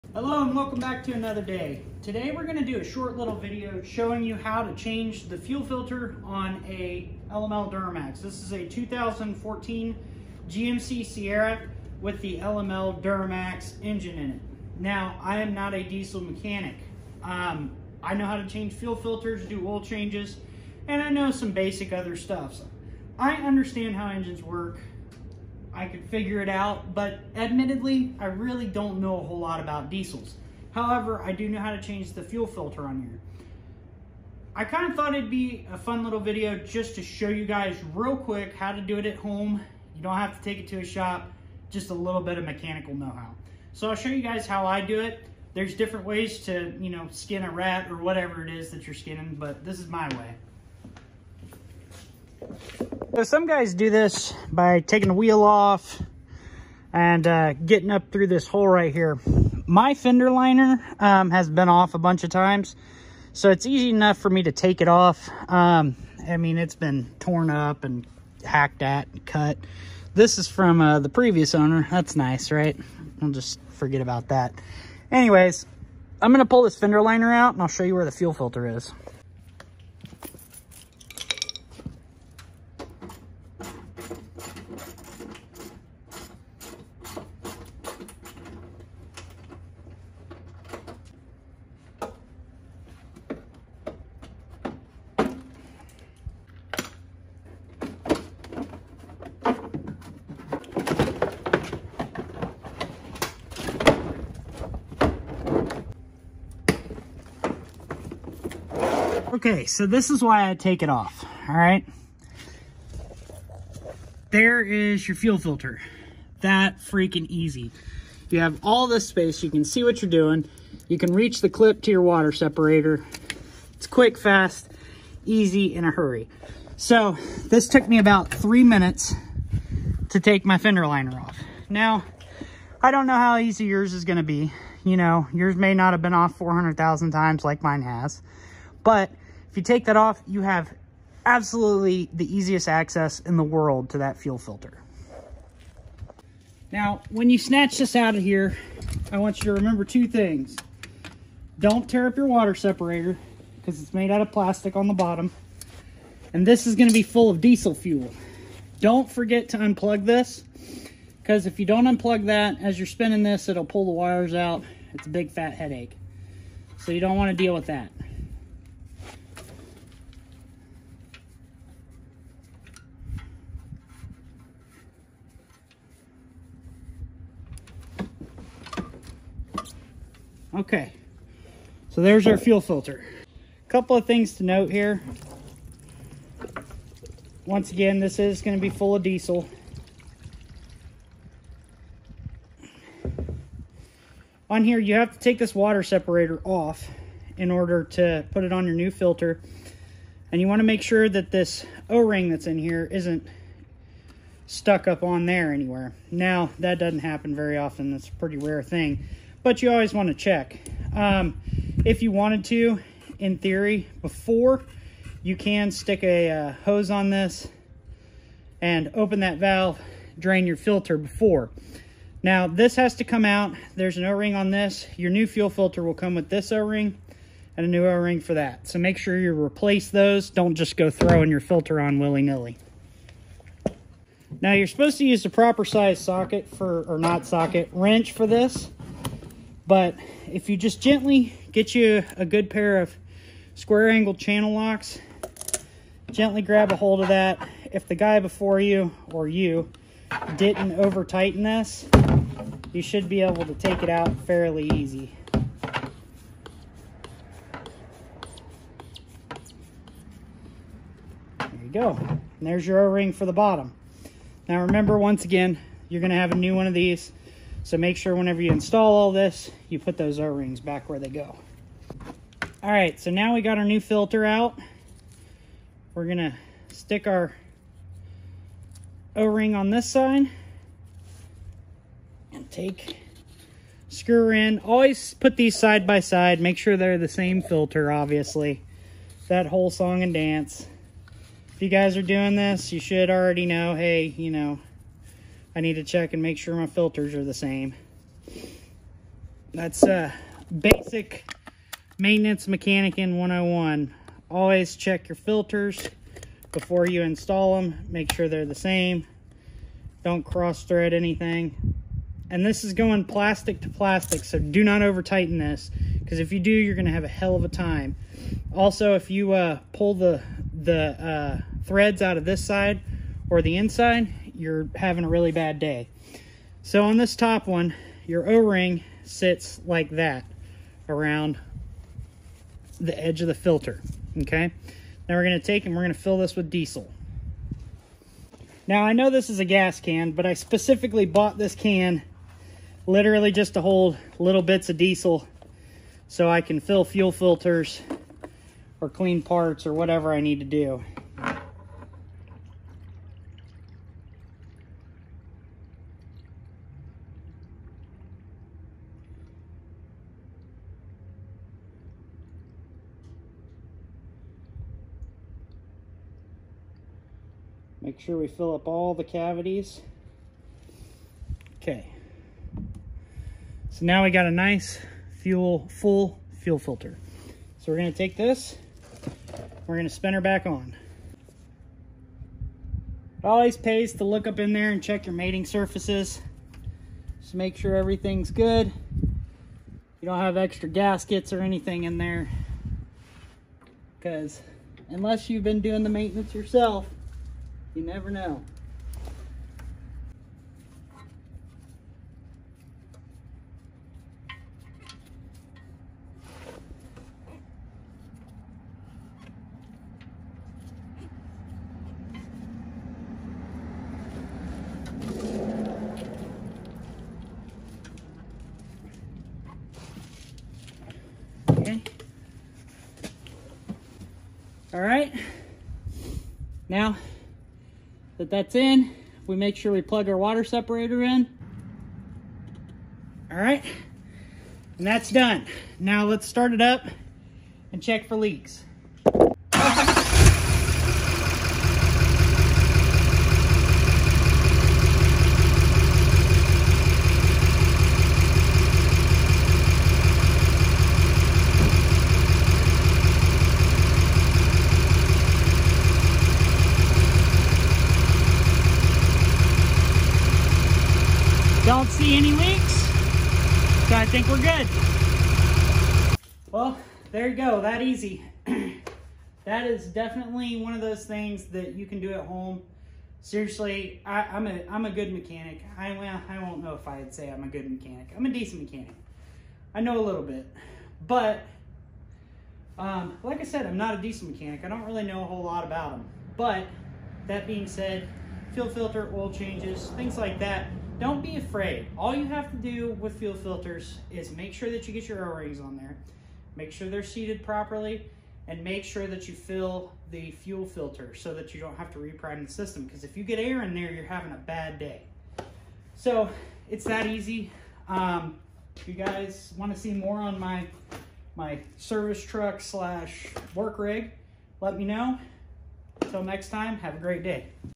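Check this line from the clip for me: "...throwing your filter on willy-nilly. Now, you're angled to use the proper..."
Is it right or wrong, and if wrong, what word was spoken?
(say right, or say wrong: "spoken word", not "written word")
wrong: "supposed", not "angled".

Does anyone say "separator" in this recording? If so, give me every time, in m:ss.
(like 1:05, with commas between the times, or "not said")
2:02, 2:32, 3:15, 7:10.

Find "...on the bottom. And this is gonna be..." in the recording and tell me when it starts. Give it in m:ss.
2:34.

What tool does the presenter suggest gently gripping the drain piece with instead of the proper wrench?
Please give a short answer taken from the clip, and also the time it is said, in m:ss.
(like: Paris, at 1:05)
channel locks, at 4:04.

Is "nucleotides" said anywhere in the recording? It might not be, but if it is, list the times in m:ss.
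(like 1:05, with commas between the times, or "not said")
not said.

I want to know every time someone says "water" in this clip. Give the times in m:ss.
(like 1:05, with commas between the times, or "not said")
2:02, 2:32, 3:15, 7:10.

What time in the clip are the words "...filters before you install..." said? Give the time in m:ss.
5:05.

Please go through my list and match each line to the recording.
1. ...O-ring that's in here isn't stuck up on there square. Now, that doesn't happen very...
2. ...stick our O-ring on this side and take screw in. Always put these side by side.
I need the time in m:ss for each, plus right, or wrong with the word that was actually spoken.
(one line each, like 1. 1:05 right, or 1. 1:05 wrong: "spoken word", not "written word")
1. 3:21 wrong: "anywhere", not "square"
2. 4:36 right.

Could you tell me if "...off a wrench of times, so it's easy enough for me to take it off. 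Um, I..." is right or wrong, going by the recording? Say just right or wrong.
wrong.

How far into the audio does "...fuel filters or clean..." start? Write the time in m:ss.
5:46.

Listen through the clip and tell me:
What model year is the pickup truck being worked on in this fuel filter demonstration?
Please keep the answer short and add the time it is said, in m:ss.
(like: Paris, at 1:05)
2014, at 0:08.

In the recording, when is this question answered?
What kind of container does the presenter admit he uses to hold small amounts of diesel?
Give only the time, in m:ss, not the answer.
5:39.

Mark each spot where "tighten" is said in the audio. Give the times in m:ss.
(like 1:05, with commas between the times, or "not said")
4:11, 5:15.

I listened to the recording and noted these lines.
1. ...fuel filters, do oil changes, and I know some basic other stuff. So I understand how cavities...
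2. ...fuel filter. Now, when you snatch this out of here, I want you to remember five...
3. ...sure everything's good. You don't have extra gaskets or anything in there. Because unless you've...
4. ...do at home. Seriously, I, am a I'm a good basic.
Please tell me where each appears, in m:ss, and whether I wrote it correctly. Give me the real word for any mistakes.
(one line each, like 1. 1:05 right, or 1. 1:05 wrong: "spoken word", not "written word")
1. 0:18 wrong: "engines", not "cavities"
2. 2:24 wrong: "two", not "five"
3. 6:27 right
4. 7:51 wrong: "mechanic", not "basic".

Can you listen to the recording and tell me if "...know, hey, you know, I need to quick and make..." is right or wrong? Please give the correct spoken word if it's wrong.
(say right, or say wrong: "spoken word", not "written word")
wrong: "check", not "quick".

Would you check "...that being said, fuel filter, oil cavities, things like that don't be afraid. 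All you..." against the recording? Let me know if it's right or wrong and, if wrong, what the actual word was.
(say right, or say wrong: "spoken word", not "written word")
wrong: "changes", not "cavities".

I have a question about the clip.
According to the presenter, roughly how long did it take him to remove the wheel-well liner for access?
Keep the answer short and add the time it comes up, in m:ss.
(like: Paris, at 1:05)
three minutes, at 2:08.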